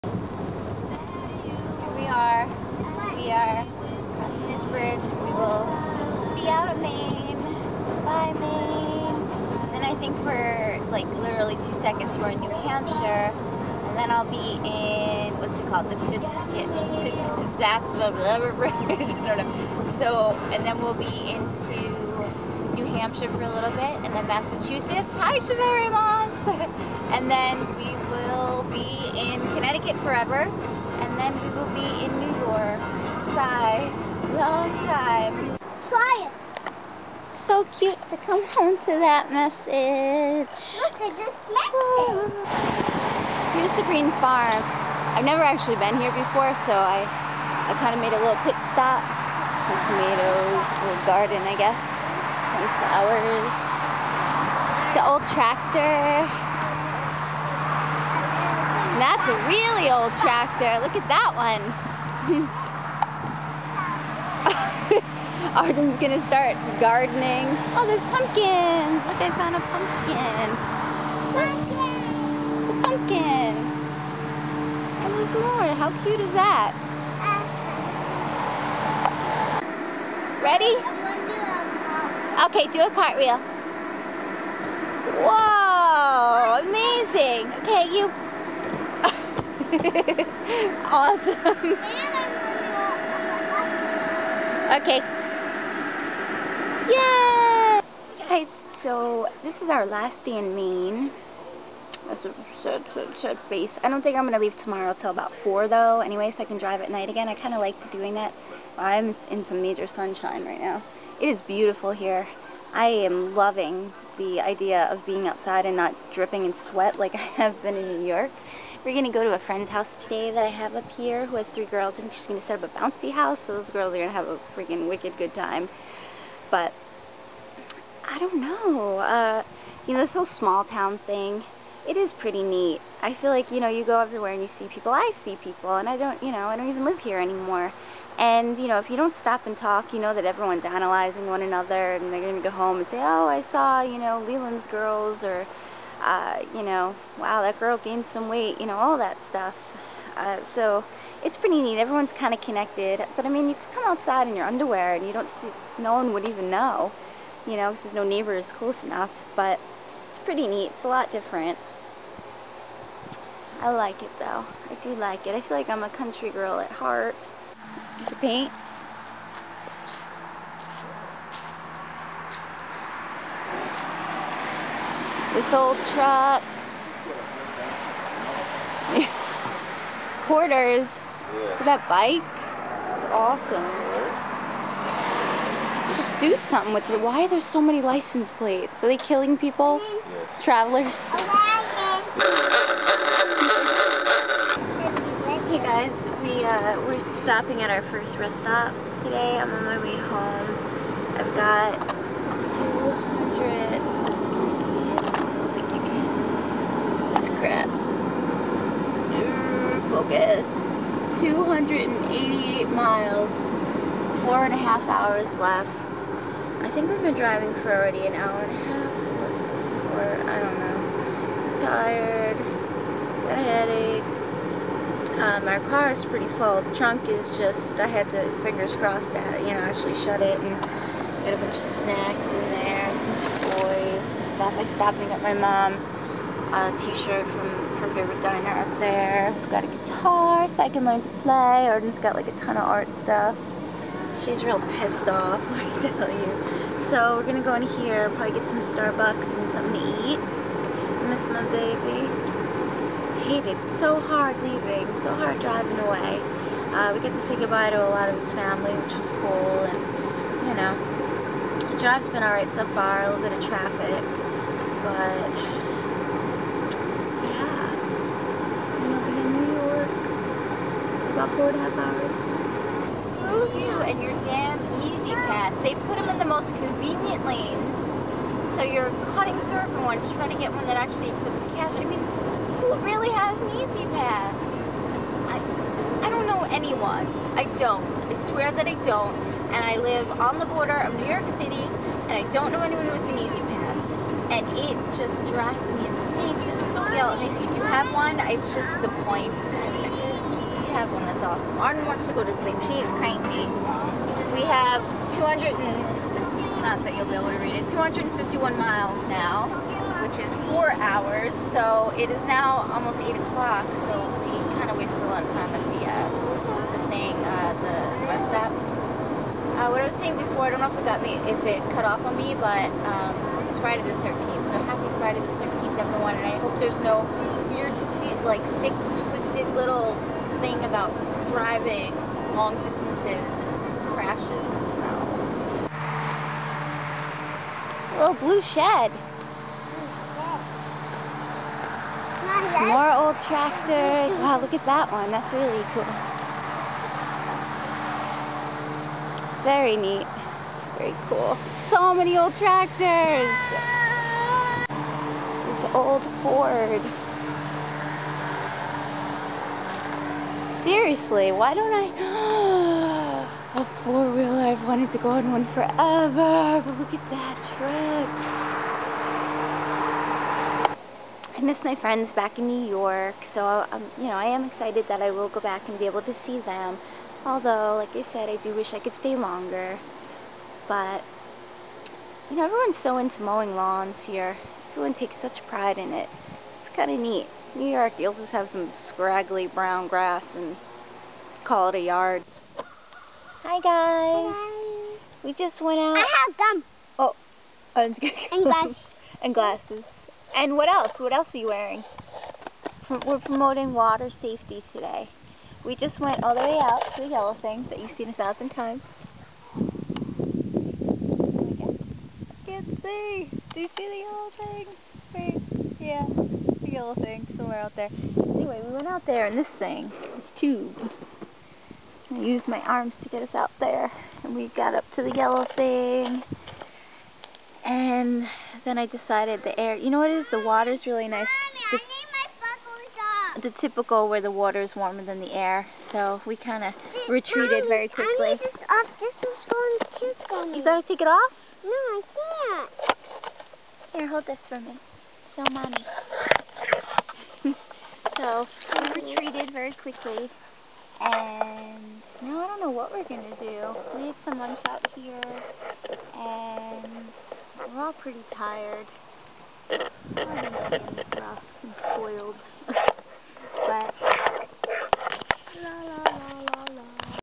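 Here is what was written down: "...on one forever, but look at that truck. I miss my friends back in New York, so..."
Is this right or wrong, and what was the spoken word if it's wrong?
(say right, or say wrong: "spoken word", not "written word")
right.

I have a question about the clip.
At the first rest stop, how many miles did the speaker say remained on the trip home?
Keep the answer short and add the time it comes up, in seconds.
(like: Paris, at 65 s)
188, at 211 s.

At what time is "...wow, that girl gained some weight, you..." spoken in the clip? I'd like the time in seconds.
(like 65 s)
147 s.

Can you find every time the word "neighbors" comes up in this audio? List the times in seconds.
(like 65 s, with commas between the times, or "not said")
158 s.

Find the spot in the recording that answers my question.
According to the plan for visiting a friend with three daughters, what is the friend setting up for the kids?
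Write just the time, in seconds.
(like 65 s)
122 s.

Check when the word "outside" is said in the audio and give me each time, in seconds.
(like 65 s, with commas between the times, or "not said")
115 s, 153 s.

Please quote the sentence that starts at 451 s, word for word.
And now I don't know what we're going to do.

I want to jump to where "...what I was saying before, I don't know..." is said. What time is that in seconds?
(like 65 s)
319 s.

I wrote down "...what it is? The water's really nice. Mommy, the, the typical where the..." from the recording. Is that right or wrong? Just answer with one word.
right.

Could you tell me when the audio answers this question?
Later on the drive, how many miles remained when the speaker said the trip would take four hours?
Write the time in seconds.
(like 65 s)
307 s.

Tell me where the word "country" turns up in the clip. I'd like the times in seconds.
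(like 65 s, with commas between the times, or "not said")
165 s.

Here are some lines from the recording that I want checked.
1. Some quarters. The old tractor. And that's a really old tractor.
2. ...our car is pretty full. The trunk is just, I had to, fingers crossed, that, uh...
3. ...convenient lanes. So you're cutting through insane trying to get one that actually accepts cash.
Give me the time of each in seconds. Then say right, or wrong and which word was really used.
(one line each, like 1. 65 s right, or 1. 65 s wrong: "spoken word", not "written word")
1. 51 s wrong: "flowers", not "quarters"
2. 225 s right
3. 276 s wrong: "everyone", not "insane".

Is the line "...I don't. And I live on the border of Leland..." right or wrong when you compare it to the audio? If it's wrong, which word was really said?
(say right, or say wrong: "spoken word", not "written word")
wrong: "New", not "Leland".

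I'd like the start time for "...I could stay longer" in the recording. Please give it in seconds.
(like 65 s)
378 s.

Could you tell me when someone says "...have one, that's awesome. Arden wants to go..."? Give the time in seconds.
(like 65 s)
300 s.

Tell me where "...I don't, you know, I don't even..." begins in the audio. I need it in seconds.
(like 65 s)
135 s.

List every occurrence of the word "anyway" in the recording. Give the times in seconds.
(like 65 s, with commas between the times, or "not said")
105 s, 418 s.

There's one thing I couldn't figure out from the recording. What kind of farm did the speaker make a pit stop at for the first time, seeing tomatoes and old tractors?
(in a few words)
green farm.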